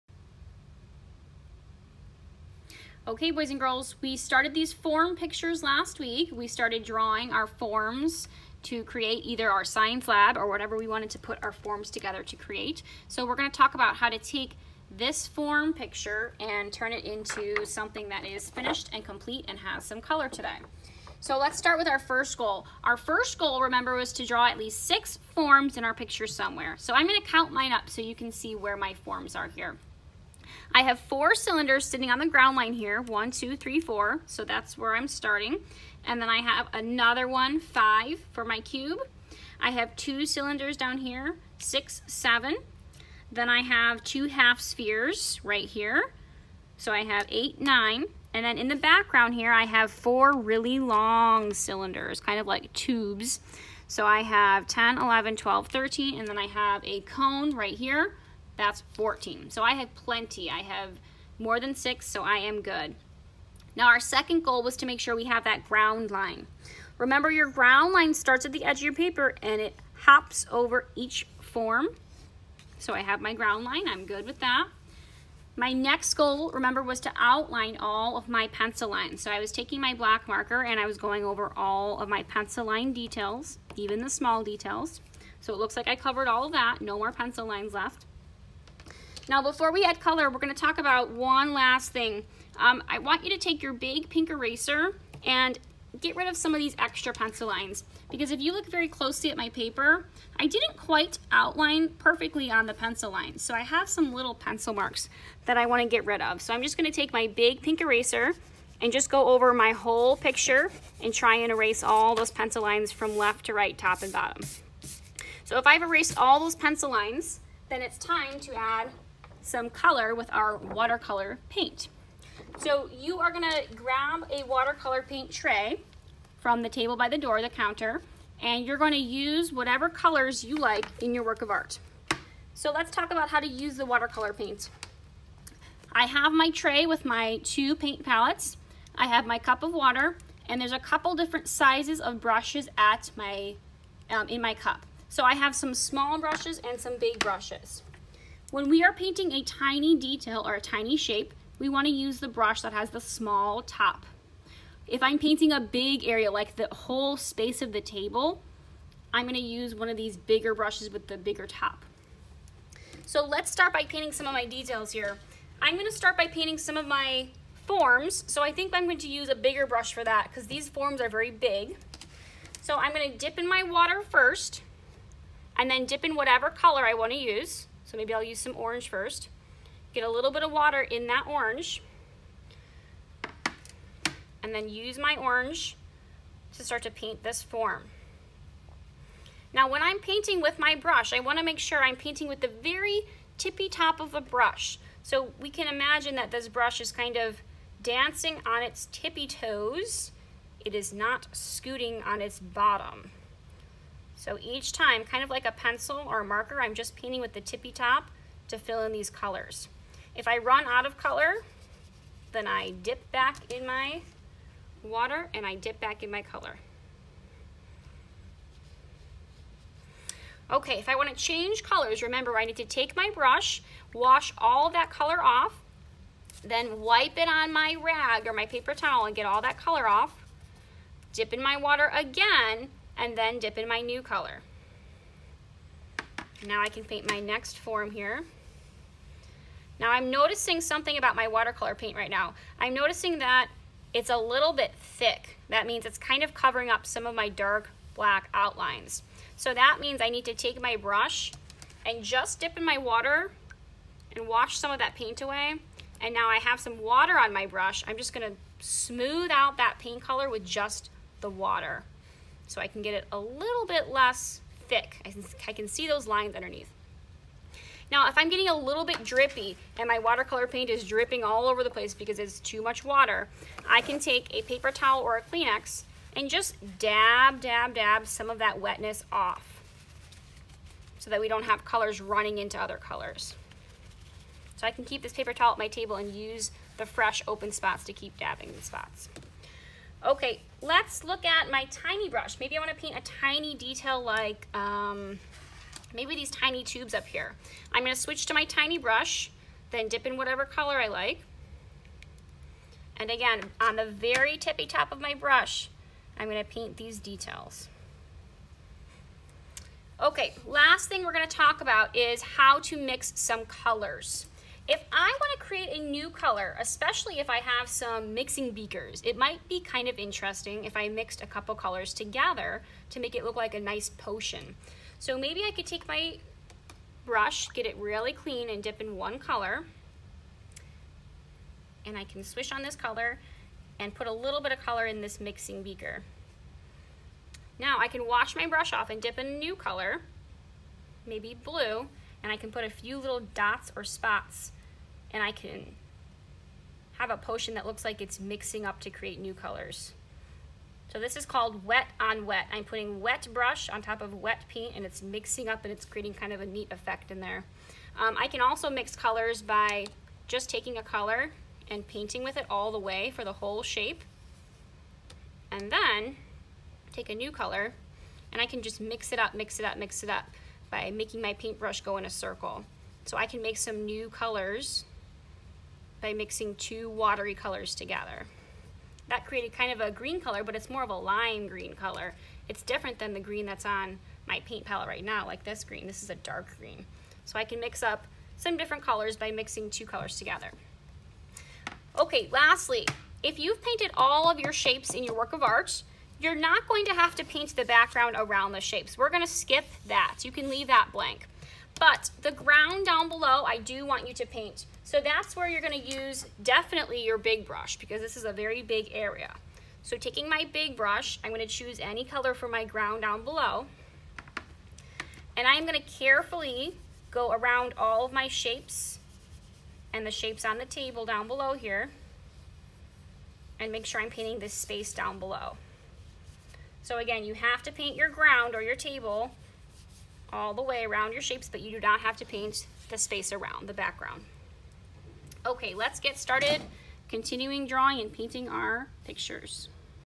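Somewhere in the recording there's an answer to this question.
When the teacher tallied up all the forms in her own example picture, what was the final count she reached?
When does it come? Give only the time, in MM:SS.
00:58.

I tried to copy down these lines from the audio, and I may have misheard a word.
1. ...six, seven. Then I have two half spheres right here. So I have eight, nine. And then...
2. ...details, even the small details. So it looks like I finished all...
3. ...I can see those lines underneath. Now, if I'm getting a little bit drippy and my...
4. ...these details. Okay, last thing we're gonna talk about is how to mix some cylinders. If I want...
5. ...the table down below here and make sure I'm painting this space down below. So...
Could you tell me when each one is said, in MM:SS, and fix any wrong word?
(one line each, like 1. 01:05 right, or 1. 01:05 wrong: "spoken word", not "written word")
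1. 00:41 right
2. 01:22 wrong: "covered", not "finished"
3. 04:25 right
4. 05:06 wrong: "colors", not "cylinders"
5. 07:00 right.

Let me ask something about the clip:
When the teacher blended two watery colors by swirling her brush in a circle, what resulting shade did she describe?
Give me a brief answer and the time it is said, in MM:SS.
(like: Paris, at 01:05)
lime green, at 06:20.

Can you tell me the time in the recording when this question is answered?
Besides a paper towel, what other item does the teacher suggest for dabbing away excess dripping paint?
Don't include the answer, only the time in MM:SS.
04:35.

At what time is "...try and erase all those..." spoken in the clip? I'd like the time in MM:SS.
01:51.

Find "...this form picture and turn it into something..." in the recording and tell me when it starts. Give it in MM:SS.
00:14.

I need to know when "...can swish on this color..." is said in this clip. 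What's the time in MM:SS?
05:32.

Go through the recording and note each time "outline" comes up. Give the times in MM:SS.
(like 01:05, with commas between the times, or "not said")
01:17, 01:41, 04:08.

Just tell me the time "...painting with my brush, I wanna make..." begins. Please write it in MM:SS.
03:09.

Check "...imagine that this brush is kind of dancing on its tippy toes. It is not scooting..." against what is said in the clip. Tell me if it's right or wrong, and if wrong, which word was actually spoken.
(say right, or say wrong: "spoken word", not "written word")
right.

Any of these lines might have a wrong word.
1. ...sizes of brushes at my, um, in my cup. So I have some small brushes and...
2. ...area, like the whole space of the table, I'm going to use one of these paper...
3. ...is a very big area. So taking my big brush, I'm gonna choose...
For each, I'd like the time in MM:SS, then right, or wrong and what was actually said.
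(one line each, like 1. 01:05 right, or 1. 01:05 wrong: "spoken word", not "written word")
1. 02:21 right
2. 02:36 wrong: "bigger", not "paper"
3. 06:48 right.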